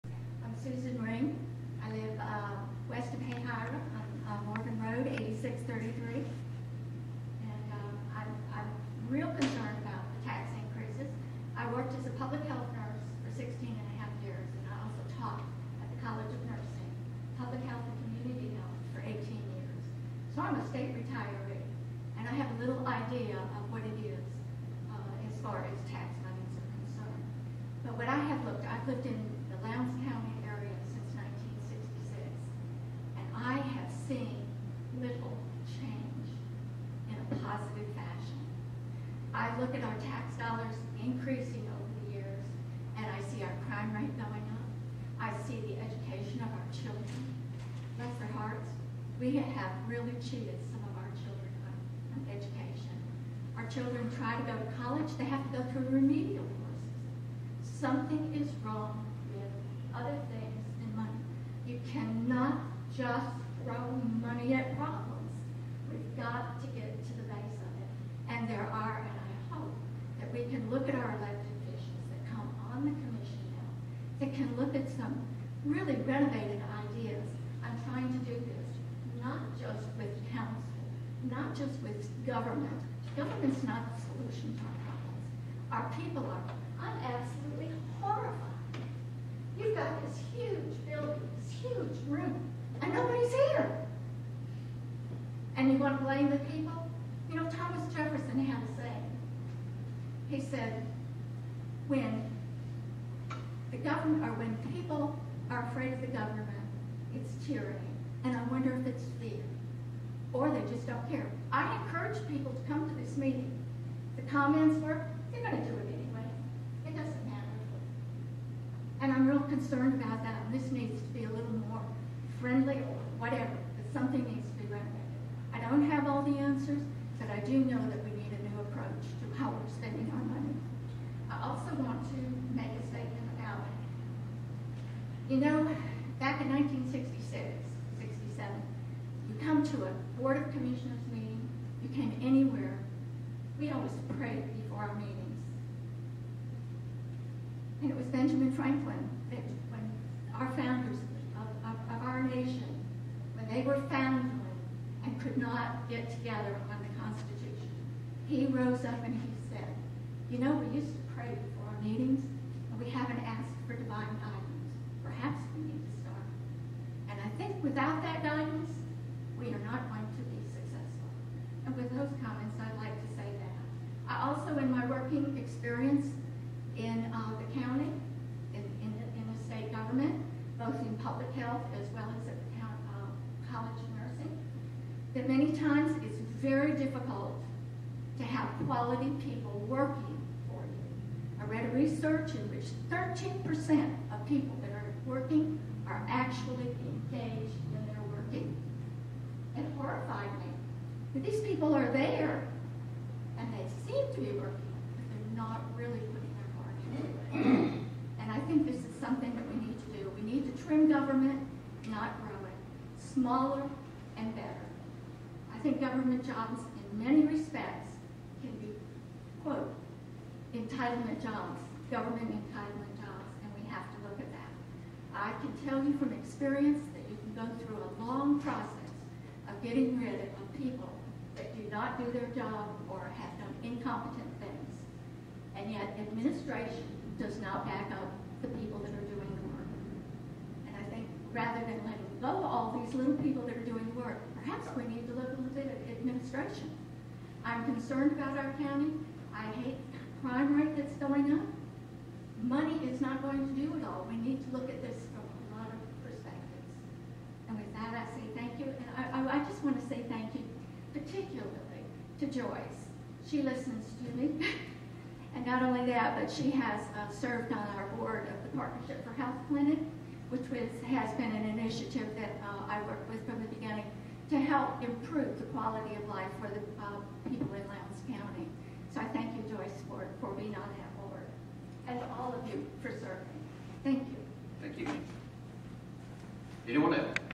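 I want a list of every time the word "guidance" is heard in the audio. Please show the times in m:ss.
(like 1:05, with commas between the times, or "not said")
2:44, 2:48.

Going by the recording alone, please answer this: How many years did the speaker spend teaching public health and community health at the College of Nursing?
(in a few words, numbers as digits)
18.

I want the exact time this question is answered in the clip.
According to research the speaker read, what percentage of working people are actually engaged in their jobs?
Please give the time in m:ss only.
3:12.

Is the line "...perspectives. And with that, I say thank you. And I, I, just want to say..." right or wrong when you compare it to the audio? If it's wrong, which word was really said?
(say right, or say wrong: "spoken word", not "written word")
right.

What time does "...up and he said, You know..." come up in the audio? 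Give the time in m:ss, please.
2:38.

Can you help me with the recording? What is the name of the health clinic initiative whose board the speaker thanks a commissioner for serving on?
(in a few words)
Partnership for Health Clinic.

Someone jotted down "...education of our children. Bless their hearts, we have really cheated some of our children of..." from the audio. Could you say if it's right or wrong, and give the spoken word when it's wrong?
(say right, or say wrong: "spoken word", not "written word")
right.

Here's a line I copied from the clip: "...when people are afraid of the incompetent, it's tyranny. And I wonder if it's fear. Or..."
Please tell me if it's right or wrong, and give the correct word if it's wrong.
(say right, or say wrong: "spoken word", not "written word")
wrong: "government", not "incompetent".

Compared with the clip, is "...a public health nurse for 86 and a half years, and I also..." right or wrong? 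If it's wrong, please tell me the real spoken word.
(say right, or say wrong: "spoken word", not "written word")
wrong: "16", not "86".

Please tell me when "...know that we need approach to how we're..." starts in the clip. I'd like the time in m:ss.
2:07.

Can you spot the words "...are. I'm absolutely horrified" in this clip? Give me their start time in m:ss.
1:26.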